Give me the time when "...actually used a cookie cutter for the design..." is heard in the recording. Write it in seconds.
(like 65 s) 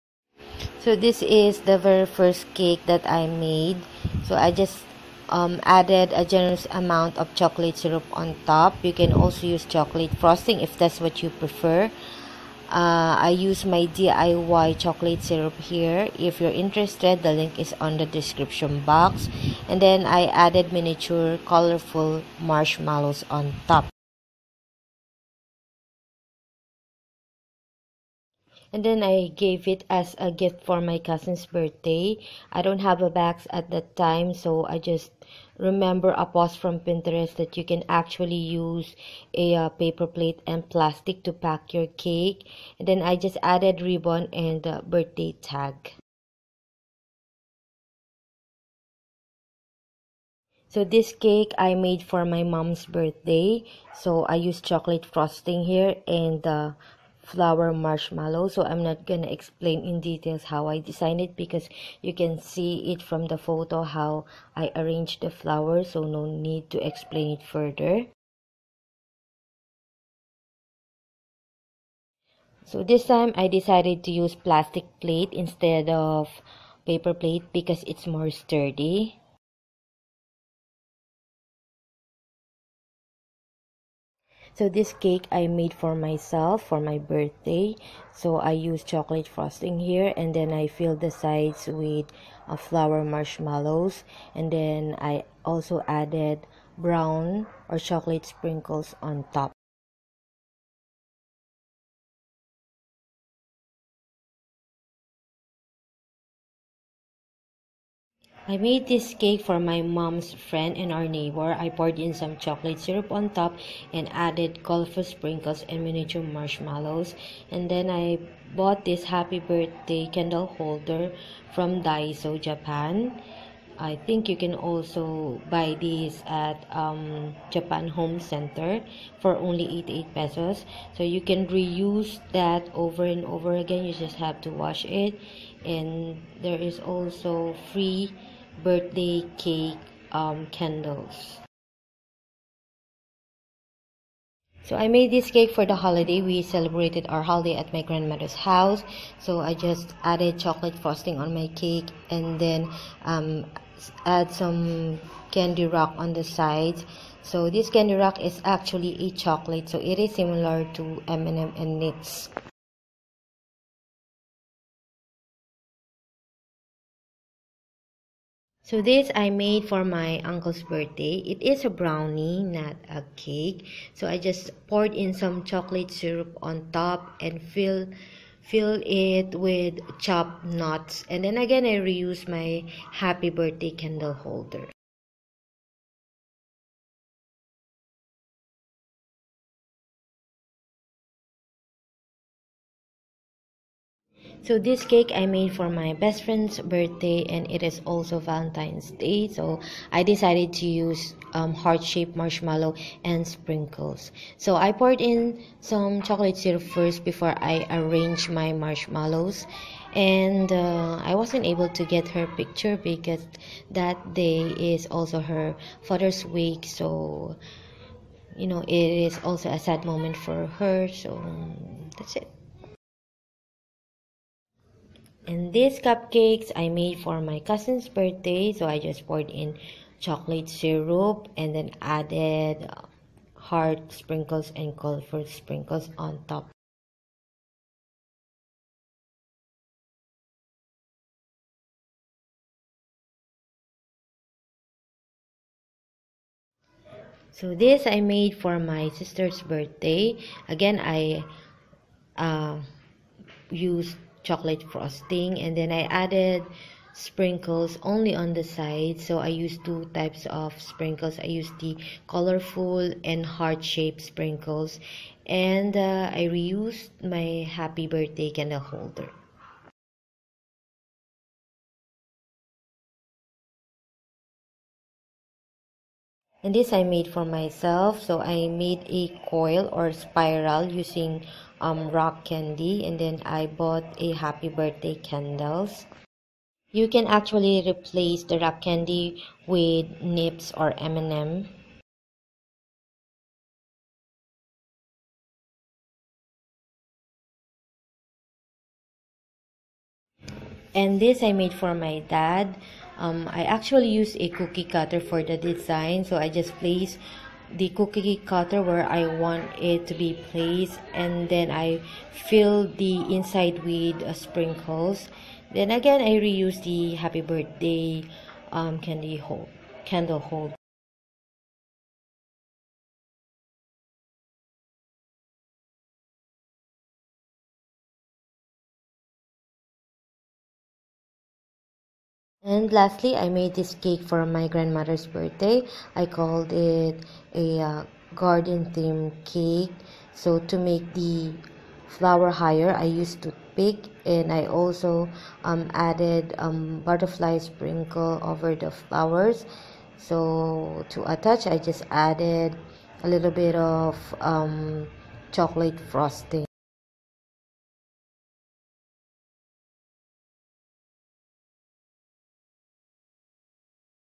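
303 s.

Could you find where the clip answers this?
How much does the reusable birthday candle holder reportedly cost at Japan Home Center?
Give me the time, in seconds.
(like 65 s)
129 s.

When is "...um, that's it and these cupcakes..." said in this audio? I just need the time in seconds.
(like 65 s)
221 s.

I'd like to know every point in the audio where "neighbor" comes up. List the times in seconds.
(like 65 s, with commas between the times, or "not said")
111 s.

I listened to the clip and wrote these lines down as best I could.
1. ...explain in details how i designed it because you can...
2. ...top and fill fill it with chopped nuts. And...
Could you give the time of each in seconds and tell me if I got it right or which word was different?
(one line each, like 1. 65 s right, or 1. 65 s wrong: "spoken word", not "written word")
1. 59 s right
2. 176 s right.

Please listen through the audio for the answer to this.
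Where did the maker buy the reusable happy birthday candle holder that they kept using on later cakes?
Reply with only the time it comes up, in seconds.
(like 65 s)
121 s.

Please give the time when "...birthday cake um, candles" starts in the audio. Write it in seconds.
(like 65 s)
138 s.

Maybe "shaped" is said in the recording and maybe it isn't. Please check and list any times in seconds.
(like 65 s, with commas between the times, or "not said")
201 s, 263 s.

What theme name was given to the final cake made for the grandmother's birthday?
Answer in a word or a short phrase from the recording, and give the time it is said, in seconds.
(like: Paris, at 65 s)
Garden theme, at 338 s.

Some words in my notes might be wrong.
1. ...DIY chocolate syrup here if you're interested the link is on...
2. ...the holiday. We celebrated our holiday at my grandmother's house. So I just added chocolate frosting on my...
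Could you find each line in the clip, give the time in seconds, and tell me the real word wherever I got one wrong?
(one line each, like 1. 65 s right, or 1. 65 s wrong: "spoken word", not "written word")
1. 13 s right
2. 145 s right.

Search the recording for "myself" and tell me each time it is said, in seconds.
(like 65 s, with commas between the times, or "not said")
85 s, 277 s.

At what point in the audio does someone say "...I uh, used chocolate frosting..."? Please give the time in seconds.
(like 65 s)
250 s.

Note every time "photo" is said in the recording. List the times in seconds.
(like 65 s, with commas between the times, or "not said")
63 s.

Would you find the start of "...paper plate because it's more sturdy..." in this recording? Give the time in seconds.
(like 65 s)
76 s.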